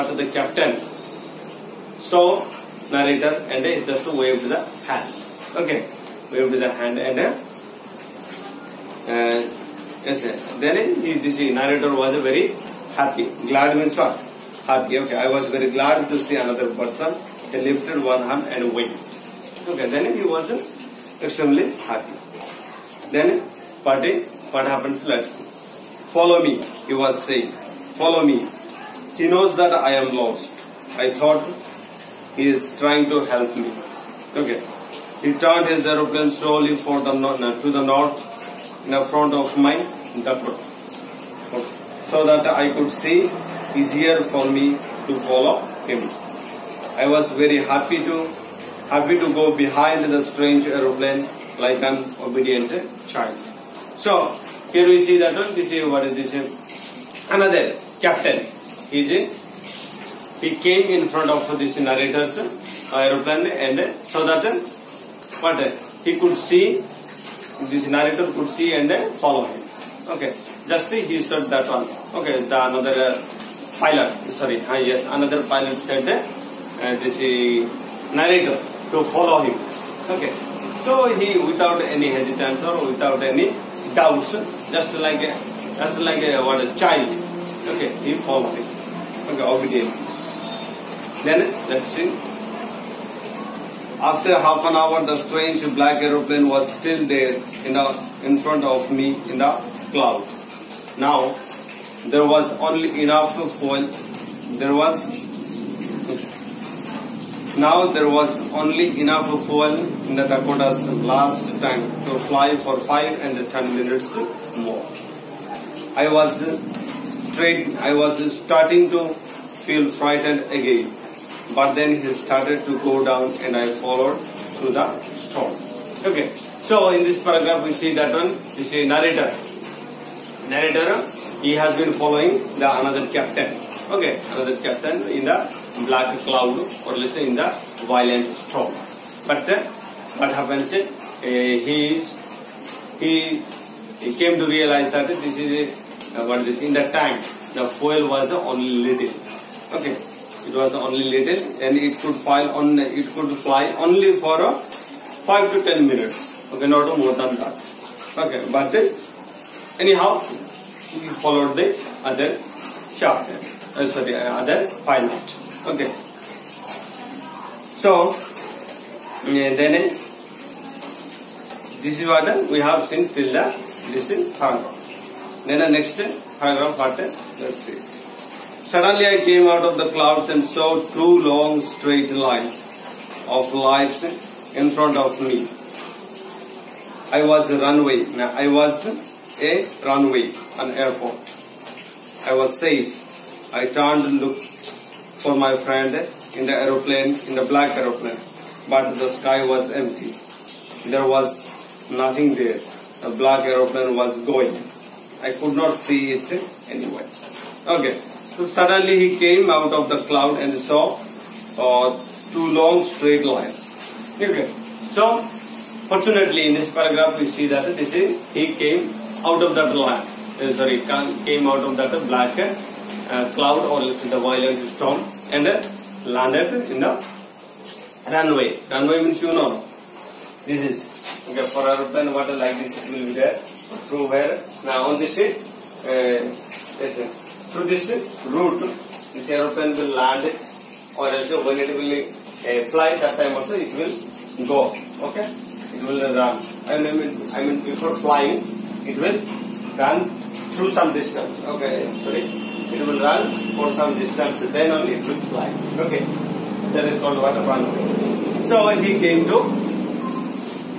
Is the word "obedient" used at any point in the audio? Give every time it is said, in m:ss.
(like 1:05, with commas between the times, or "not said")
0:52, 1:29.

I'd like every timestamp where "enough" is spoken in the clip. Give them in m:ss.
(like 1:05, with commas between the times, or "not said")
1:43, 1:48.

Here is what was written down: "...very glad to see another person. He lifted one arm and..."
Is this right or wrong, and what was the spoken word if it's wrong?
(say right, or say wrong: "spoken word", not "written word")
right.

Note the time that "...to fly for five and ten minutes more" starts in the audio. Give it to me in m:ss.
1:52.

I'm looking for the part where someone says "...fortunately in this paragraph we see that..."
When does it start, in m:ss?
3:35.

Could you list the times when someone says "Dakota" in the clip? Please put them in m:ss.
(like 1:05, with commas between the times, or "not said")
0:40, 1:50.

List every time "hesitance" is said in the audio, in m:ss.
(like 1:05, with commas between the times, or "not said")
1:22.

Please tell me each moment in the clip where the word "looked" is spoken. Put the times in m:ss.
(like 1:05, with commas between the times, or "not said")
3:14.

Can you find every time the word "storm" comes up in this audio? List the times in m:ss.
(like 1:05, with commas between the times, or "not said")
2:05, 2:18, 3:44.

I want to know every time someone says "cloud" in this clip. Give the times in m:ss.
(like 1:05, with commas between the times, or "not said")
1:39, 2:16, 2:59, 3:30, 3:43.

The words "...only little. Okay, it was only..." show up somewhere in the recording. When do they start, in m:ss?
2:28.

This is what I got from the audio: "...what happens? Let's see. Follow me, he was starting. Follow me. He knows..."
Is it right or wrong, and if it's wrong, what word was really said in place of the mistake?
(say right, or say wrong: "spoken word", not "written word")
wrong: "saying", not "starting".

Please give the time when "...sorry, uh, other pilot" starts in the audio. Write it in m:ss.
2:43.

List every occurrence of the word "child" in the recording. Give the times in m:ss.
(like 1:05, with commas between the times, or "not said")
0:53, 1:26.